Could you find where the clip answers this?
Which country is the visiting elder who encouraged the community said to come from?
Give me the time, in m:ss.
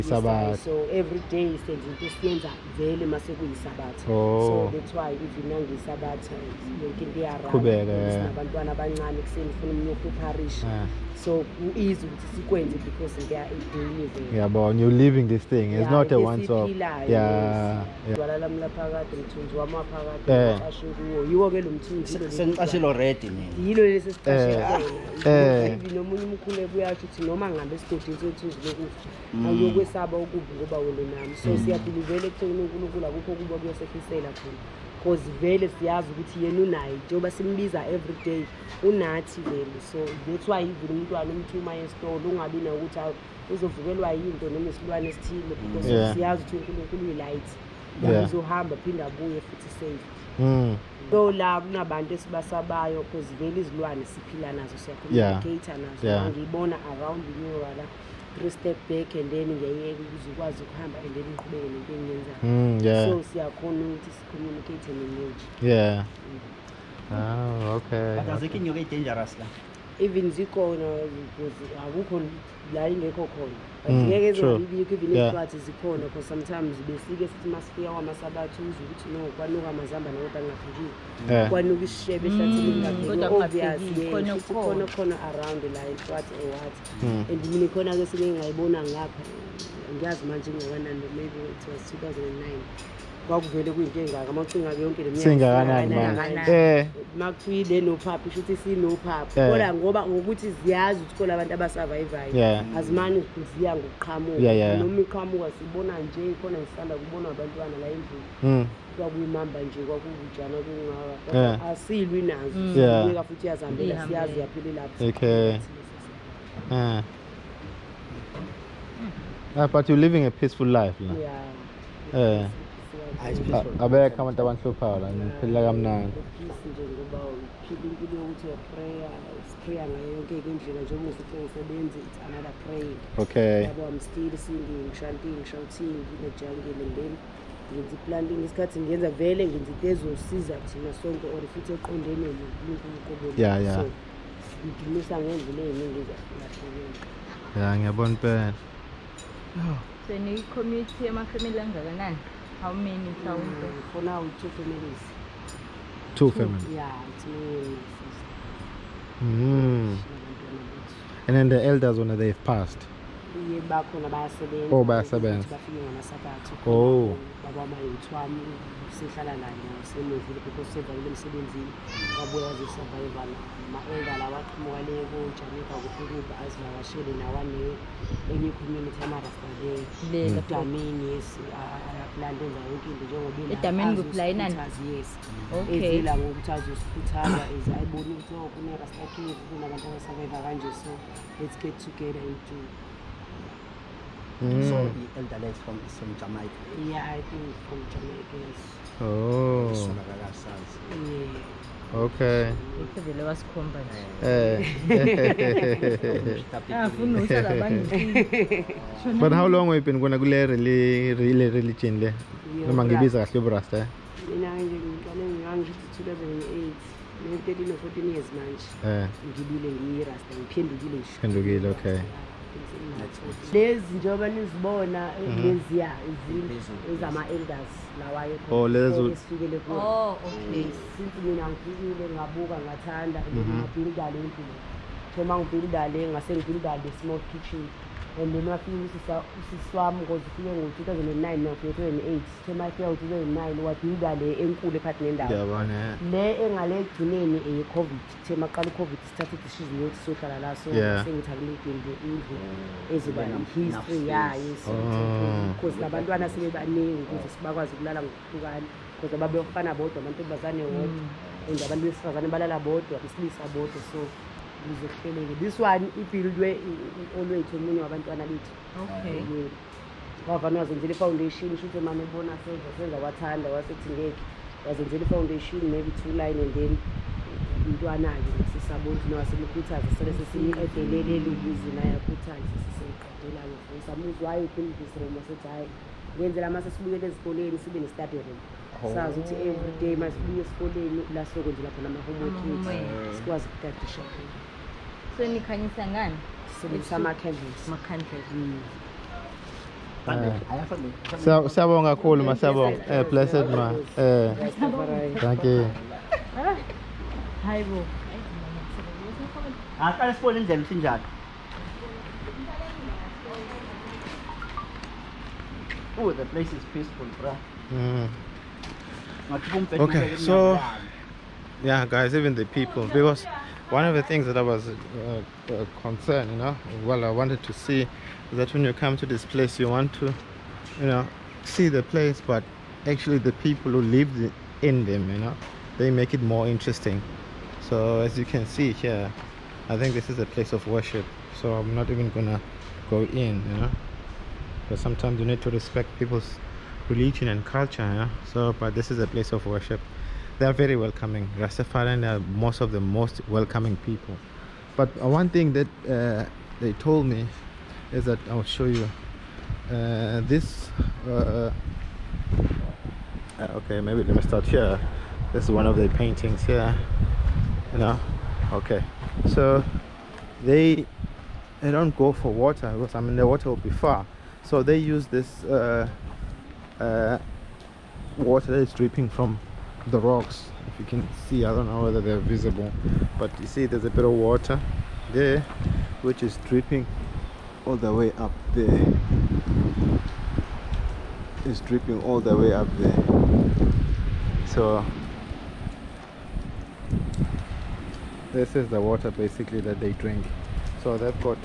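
3:16.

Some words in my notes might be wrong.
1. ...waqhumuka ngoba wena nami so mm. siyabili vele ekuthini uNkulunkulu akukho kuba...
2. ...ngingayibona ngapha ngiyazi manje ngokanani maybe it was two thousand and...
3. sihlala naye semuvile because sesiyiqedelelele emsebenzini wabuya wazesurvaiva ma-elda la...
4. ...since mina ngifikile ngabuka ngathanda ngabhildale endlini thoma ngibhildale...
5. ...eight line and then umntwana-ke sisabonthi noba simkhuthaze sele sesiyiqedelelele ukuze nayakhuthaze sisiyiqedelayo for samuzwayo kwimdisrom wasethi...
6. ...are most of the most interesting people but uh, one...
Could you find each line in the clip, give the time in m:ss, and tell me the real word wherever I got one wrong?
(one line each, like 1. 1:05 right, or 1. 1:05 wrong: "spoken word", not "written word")
1. 0:30 wrong: "ukuvuka", not "waqhumuka"
2. 1:28 right
3. 2:48 wrong: "sevalele", not "sesiyiqedelelele"
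4. 3:50 right
5. 4:36 wrong: "two", not "eight"
6. 5:52 wrong: "welcoming", not "interesting".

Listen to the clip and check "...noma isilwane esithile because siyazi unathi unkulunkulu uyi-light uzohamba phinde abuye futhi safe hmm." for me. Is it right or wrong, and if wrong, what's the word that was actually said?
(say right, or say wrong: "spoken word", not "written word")
wrong: "ukuthi", not "unathi".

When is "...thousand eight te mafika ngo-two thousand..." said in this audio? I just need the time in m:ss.
4:01.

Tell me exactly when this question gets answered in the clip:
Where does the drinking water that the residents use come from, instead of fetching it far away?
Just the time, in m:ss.
6:18.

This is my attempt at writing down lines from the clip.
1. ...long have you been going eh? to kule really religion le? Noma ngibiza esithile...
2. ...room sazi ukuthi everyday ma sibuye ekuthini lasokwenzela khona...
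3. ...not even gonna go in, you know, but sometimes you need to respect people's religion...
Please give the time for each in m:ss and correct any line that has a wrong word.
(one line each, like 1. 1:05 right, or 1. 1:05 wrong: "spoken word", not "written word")
1. 3:29 wrong: "kahle", not "esithile"
2. 4:48 wrong: "esikoleni", not "ekuthini"
3. 5:41 right.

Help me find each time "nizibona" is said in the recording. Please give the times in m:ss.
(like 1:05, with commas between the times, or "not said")
3:44.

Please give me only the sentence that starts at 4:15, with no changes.
cause labantwana sebebaningi ukuze sibakwazi ukulala ngokuhlukane cause ababefana bodwa abantu bazane wodwa mm.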